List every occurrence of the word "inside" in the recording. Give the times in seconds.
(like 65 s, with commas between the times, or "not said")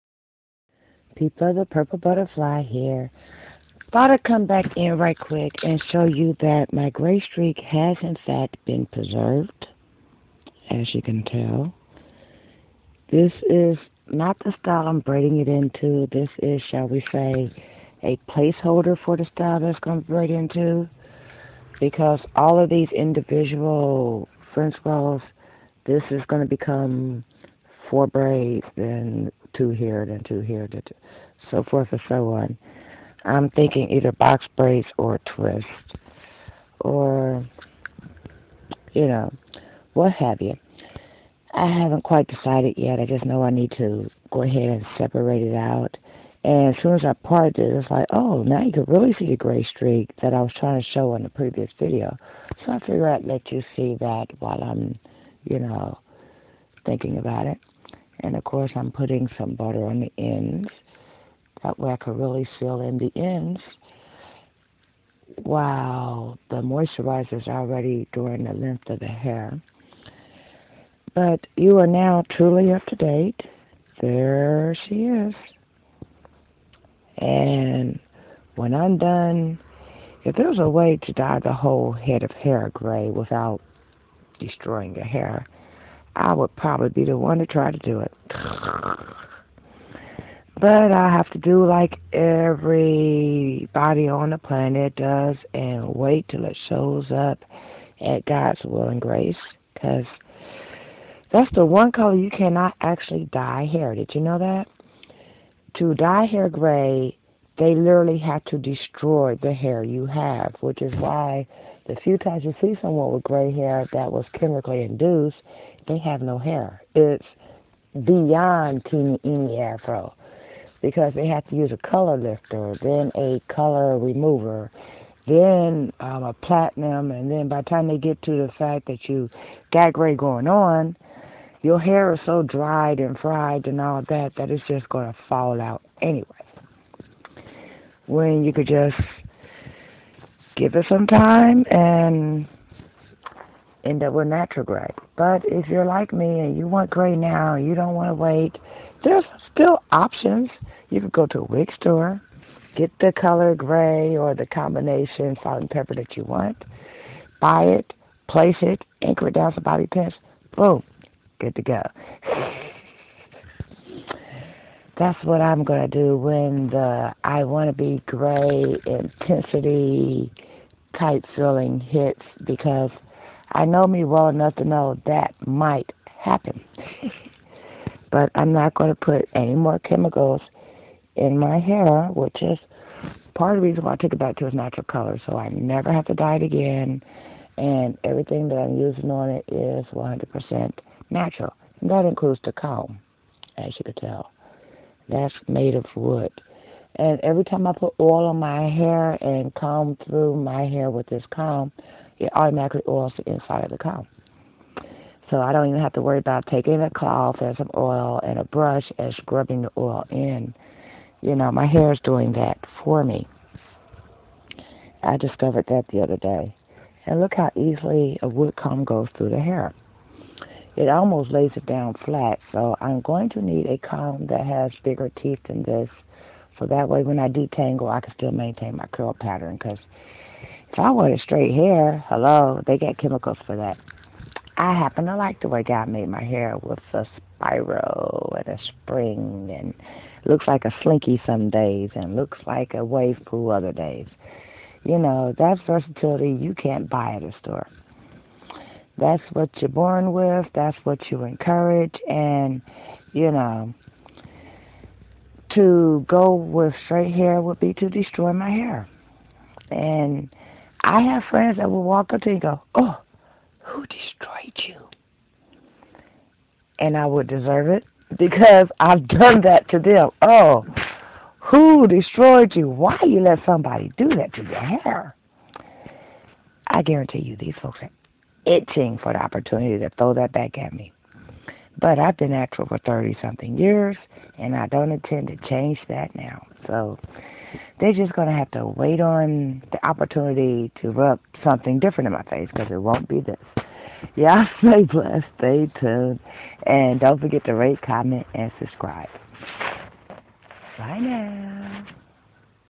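203 s.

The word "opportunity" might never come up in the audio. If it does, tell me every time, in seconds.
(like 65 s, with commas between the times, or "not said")
279 s, 289 s.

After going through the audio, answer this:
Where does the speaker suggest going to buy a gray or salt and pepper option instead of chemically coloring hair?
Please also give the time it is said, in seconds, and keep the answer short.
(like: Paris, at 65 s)
wig store, at 151 s.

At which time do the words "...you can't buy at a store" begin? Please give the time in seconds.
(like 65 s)
246 s.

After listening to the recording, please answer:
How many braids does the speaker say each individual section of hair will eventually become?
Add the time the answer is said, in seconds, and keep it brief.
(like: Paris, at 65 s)
4, at 27 s.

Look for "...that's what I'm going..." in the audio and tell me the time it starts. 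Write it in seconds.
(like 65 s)
165 s.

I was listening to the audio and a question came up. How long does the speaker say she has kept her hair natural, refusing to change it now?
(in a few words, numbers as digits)
30 something years.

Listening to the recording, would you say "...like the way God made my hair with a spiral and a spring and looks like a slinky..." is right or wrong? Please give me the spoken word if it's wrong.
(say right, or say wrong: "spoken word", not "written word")
right.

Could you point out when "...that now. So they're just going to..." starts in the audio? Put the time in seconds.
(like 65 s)
285 s.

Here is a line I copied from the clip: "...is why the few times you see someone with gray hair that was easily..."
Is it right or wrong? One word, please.
wrong.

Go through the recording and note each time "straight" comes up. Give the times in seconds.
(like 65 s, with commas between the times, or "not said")
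231 s, 256 s.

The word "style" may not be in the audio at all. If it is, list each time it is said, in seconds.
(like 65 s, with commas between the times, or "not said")
14 s, 19 s.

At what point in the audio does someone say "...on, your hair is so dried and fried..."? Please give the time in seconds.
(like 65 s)
130 s.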